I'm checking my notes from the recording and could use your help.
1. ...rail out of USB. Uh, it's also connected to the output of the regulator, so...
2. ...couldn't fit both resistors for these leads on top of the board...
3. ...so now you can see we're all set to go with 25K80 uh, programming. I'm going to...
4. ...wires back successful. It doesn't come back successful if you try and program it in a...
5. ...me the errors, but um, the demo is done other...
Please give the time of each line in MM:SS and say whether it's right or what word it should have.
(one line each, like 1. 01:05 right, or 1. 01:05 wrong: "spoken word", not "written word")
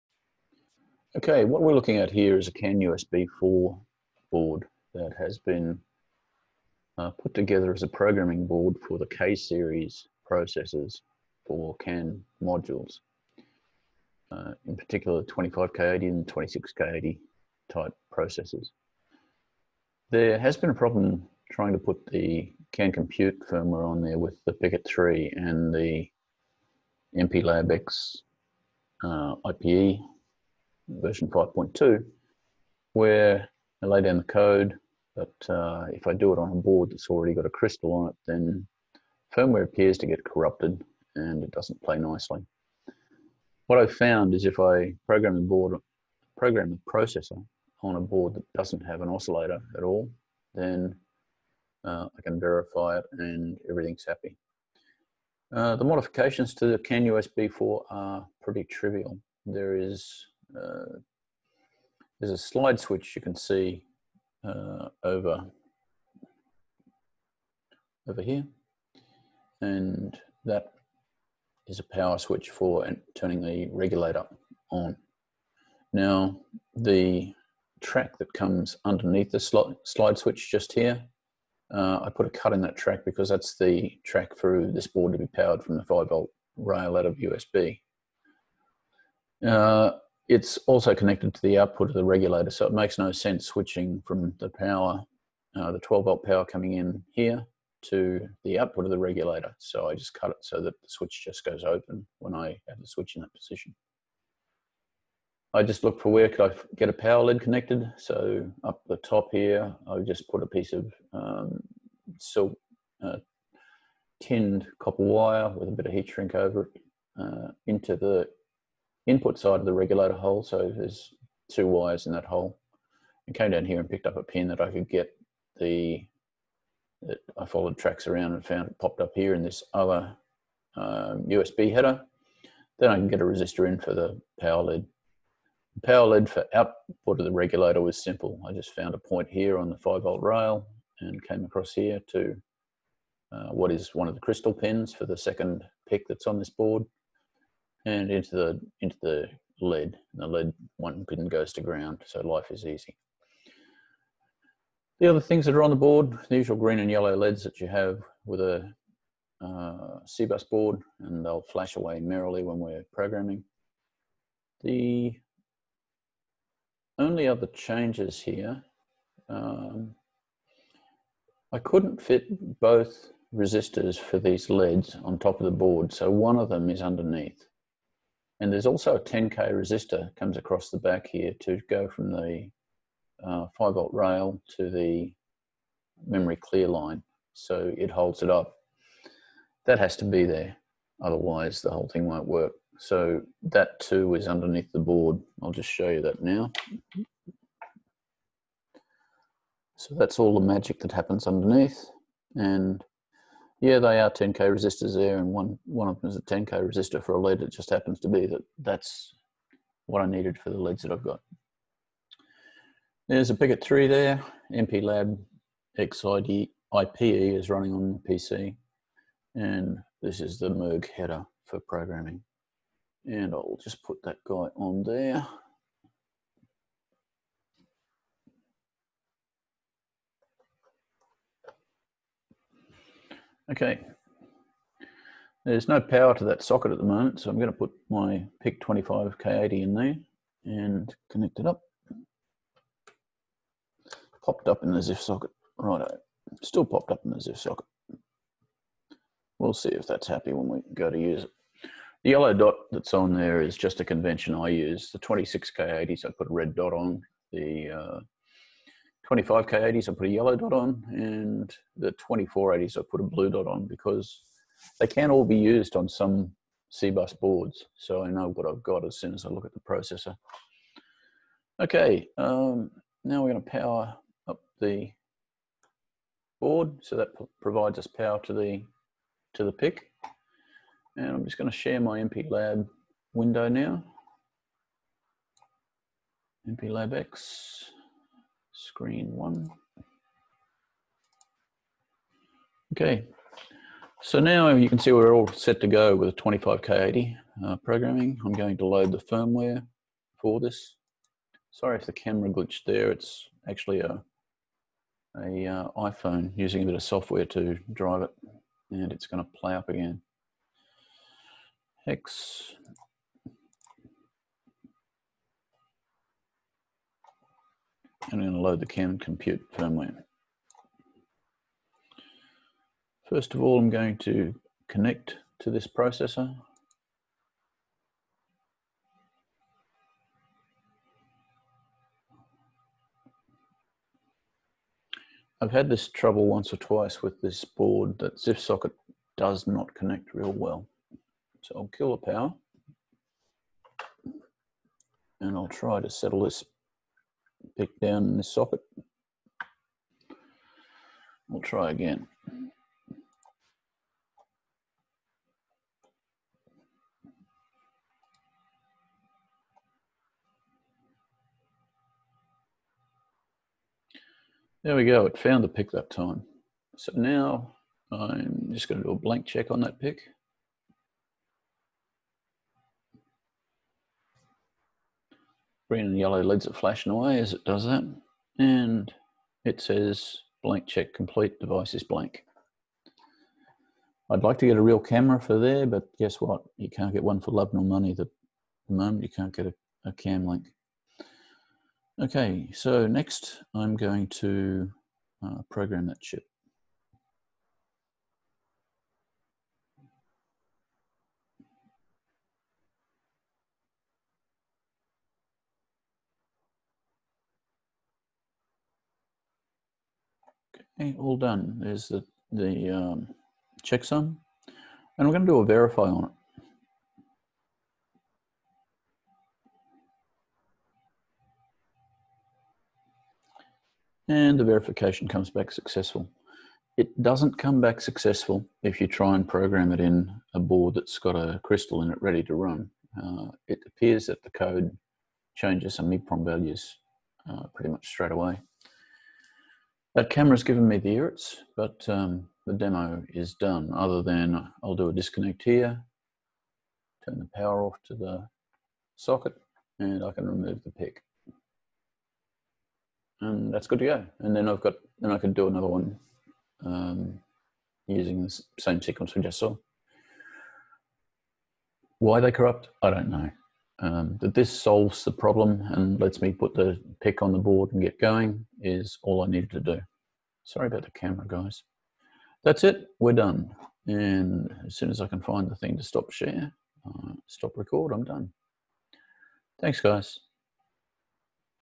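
1. 01:26 right
2. 02:51 right
3. 04:54 right
4. 07:05 wrong: "comes", not "wires"
5. 07:20 right.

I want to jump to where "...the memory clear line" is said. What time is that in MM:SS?
03:04.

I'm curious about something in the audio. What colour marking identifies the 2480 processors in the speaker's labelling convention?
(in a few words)
Blue.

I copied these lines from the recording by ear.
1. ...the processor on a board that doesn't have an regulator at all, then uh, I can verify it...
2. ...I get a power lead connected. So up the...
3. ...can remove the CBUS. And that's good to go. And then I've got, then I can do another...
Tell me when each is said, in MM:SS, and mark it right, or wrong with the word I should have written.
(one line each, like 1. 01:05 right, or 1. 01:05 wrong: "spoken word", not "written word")
1. 00:46 wrong: "oscillator", not "regulator"
2. 01:46 right
3. 07:30 wrong: "PIC", not "CBUS".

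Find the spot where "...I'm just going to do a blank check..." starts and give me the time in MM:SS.
06:07.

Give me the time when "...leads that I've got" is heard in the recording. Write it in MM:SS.
03:30.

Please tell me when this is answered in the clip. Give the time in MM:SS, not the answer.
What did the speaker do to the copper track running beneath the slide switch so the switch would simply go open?
01:22.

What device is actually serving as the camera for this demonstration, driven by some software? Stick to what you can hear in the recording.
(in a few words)
iPhone.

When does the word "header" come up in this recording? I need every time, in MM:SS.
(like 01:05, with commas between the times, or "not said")
02:11, 03:40.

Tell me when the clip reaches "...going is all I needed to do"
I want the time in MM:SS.
07:47.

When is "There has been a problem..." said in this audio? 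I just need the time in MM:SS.
00:20.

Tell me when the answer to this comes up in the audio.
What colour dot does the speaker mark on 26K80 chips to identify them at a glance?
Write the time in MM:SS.
04:16.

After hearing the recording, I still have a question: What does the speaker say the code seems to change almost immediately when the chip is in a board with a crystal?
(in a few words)
EEPROM values.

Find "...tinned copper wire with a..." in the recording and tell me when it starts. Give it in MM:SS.
01:54.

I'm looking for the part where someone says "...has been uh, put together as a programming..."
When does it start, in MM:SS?
00:05.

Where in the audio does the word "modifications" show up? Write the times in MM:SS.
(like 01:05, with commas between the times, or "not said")
00:55.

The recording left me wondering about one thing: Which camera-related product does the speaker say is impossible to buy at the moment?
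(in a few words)
Cam link.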